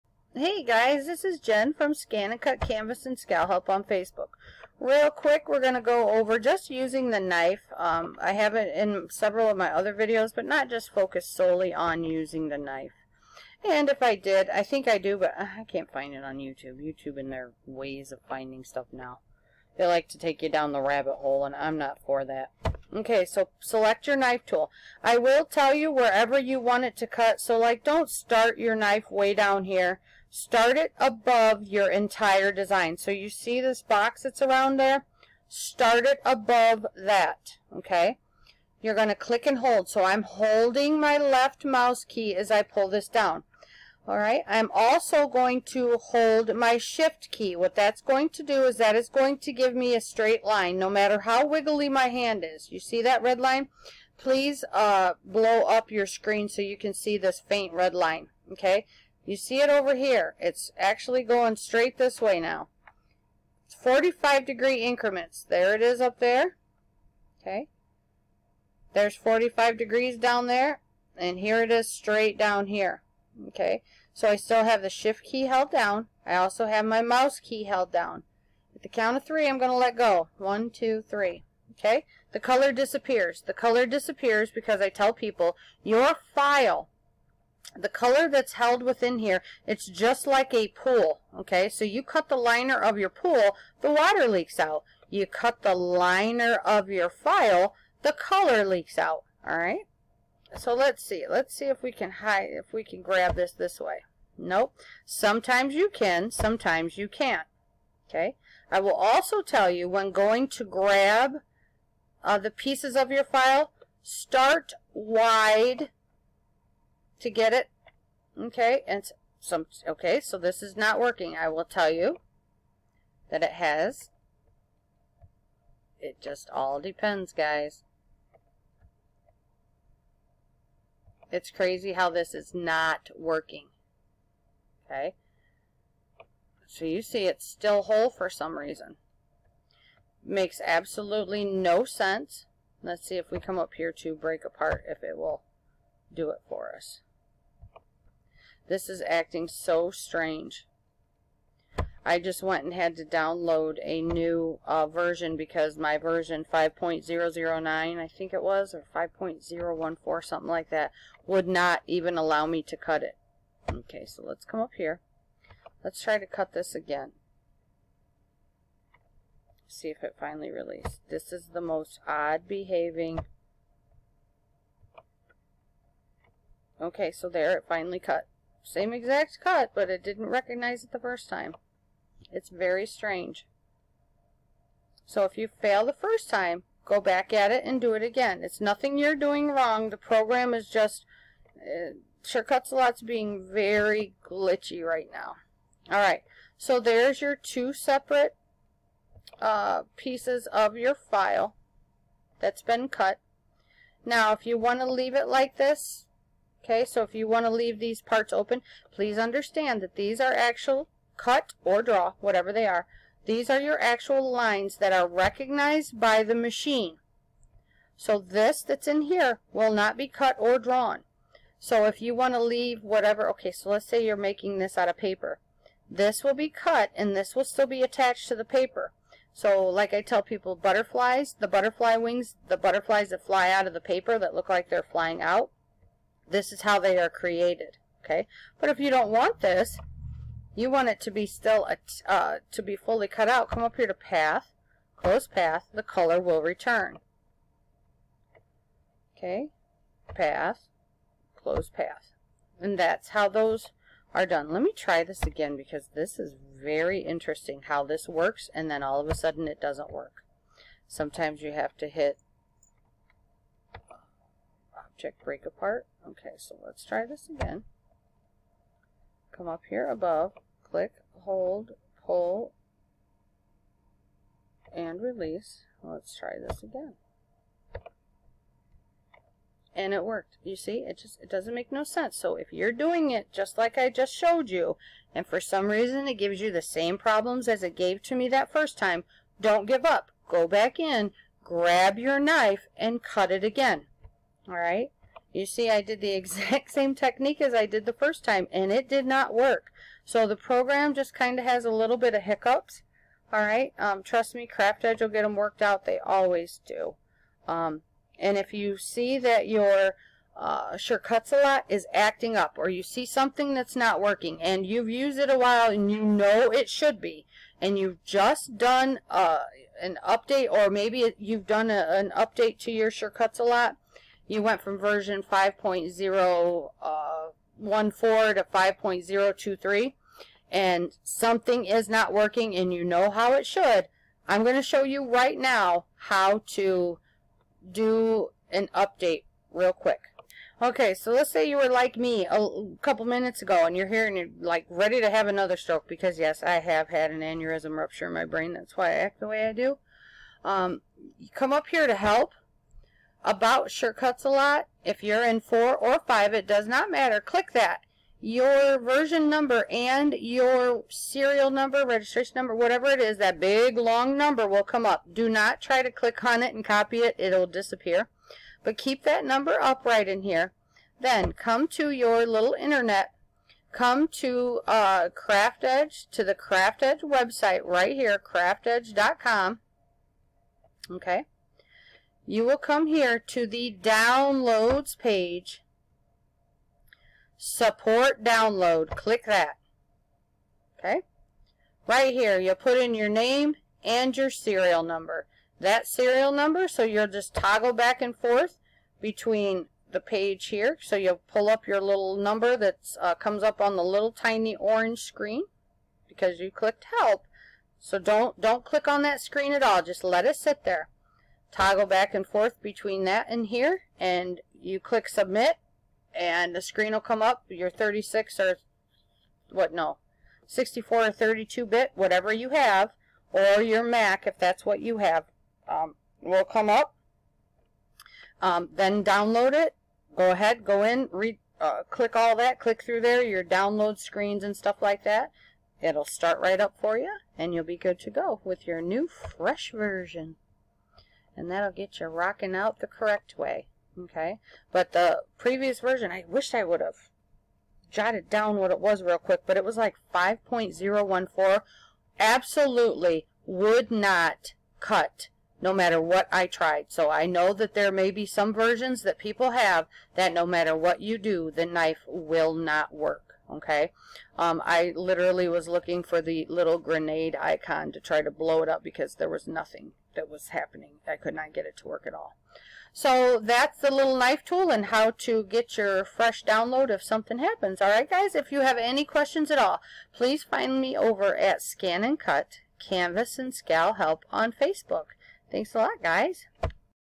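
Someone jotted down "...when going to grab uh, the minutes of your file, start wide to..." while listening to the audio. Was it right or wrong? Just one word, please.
wrong.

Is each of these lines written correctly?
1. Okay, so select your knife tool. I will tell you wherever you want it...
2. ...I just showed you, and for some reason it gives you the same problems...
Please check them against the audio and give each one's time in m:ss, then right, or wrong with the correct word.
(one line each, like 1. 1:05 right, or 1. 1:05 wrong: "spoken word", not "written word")
1. 0:22 right
2. 4:43 right.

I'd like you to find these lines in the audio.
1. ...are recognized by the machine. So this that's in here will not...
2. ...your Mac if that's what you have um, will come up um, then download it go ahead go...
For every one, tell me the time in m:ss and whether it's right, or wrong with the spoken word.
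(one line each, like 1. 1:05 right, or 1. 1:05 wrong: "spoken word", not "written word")
1. 3:34 right
2. 7:03 right.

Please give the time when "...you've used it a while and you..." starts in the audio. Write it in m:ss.
5:14.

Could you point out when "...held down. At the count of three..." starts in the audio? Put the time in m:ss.
1:17.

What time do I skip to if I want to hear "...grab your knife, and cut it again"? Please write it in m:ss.
4:51.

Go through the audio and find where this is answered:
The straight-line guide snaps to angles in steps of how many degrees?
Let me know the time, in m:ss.
1:03.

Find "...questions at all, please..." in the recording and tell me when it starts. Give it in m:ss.
7:59.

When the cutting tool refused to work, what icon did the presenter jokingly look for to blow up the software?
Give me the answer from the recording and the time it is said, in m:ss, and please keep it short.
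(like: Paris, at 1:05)
Grenade icon, at 7:46.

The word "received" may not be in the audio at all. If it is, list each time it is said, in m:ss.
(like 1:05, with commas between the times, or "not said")
not said.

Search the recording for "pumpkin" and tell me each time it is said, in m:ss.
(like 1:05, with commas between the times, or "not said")
not said.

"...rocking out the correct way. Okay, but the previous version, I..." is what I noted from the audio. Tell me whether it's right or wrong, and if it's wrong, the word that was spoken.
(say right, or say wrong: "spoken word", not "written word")
right.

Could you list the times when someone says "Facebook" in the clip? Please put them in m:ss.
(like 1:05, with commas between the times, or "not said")
0:03, 8:04.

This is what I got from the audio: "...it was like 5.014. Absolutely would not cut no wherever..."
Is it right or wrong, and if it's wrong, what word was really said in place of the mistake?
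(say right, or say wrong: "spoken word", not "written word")
wrong: "matter", not "wherever".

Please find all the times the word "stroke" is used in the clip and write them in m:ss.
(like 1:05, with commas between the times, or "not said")
5:45.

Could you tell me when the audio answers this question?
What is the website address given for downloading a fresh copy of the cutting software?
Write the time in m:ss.
6:18.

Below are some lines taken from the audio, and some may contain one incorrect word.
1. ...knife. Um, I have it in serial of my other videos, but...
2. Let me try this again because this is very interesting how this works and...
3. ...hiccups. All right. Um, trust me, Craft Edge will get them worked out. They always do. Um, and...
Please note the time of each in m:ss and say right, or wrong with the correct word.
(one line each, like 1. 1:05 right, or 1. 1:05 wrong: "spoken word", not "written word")
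1. 0:07 wrong: "several", not "serial"
2. 4:14 right
3. 5:02 right.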